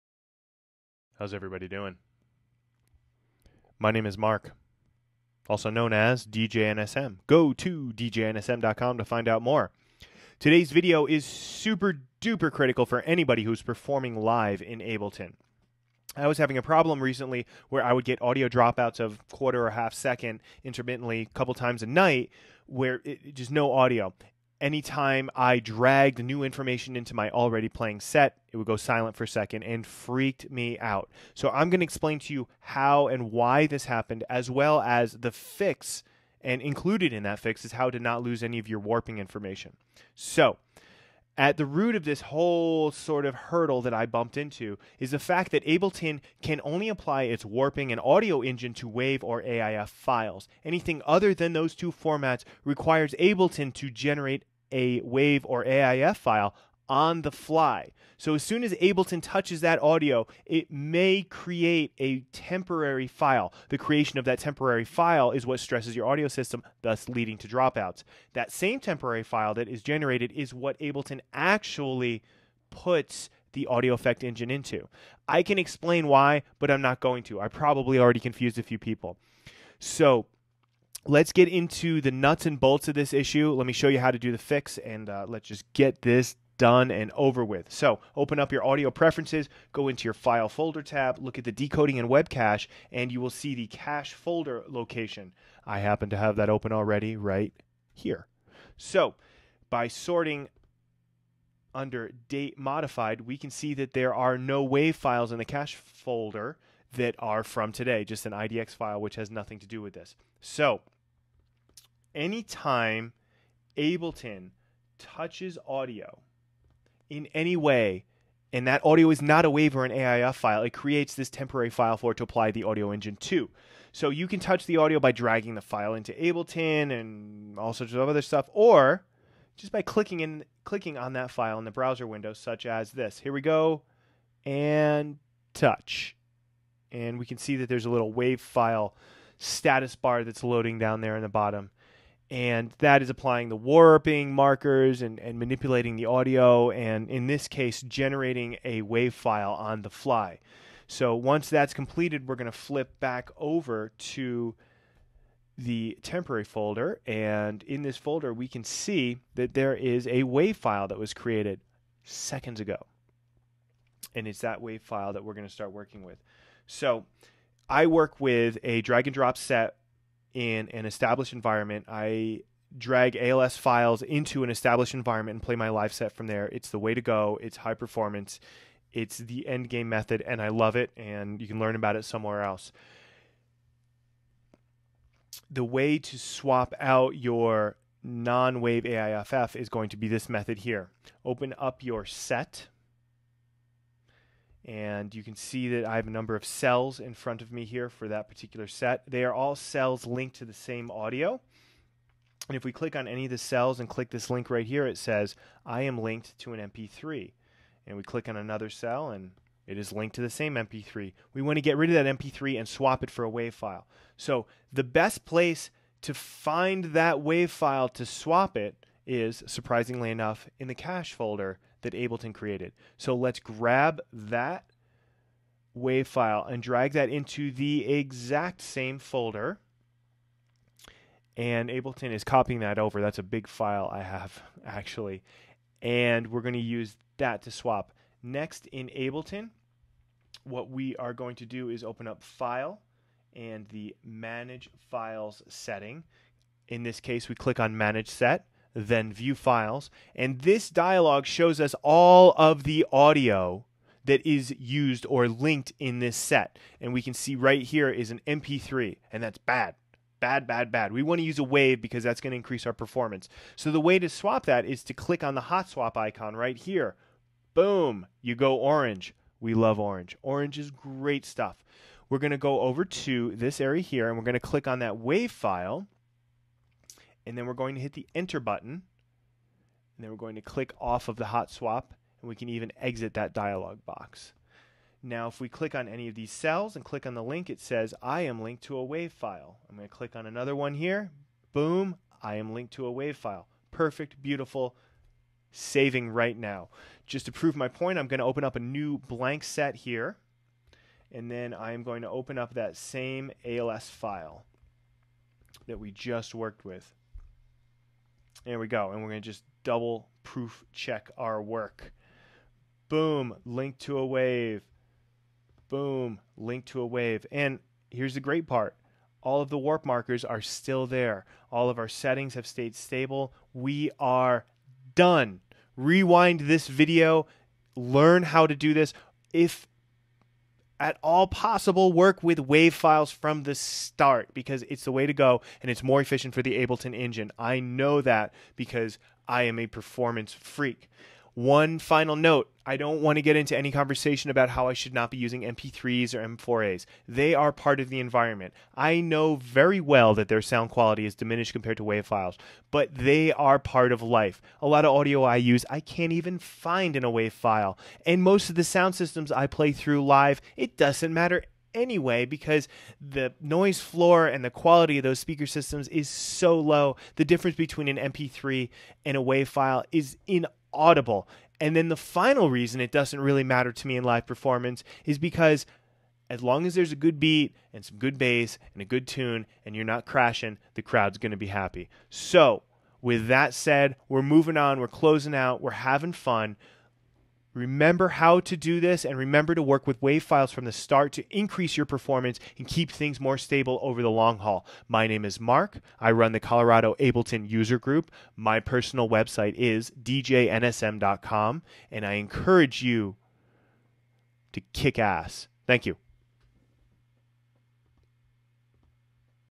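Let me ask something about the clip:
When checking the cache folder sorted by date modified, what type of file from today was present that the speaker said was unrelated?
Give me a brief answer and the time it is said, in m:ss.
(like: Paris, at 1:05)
IDX file, at 1:48.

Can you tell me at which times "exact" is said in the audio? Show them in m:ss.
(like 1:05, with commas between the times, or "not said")
3:47.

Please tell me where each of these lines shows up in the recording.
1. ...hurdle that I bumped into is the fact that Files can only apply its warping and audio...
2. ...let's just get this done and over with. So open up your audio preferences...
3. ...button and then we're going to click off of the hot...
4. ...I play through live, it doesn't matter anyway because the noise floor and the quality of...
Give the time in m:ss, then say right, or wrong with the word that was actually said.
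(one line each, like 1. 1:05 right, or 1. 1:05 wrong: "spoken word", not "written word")
1. 0:43 wrong: "Ableton", not "Files"
2. 1:25 right
3. 4:38 right
4. 5:59 right.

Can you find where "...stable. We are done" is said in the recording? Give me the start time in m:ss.
5:22.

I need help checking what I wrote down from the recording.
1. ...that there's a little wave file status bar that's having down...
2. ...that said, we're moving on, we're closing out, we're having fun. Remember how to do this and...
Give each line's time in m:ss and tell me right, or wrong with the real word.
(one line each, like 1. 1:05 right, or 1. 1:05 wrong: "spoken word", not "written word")
1. 2:17 wrong: "loading", not "having"
2. 6:23 right.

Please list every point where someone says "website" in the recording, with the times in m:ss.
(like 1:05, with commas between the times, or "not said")
6:39.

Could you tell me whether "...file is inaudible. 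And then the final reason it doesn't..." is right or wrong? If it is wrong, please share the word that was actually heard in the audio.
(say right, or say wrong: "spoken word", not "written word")
right.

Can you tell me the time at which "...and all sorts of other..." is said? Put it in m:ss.
2:06.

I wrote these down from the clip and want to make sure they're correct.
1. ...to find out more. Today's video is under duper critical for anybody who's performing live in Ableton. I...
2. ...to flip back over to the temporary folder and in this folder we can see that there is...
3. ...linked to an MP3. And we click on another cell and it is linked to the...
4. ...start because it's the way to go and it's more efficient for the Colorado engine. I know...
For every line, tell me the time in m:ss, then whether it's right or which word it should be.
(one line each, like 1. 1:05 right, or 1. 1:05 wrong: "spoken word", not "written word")
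1. 0:08 wrong: "super", not "under"
2. 2:32 right
3. 3:26 right
4. 5:33 wrong: "Ableton", not "Colorado".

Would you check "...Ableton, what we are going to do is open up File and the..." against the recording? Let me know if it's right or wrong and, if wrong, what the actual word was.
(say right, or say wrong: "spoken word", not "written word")
right.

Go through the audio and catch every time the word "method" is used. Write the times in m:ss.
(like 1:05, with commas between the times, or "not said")
2:59, 3:10.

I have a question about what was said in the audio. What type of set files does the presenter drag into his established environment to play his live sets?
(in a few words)
ALS files.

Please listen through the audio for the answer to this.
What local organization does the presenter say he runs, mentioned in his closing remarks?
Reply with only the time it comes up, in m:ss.
6:36.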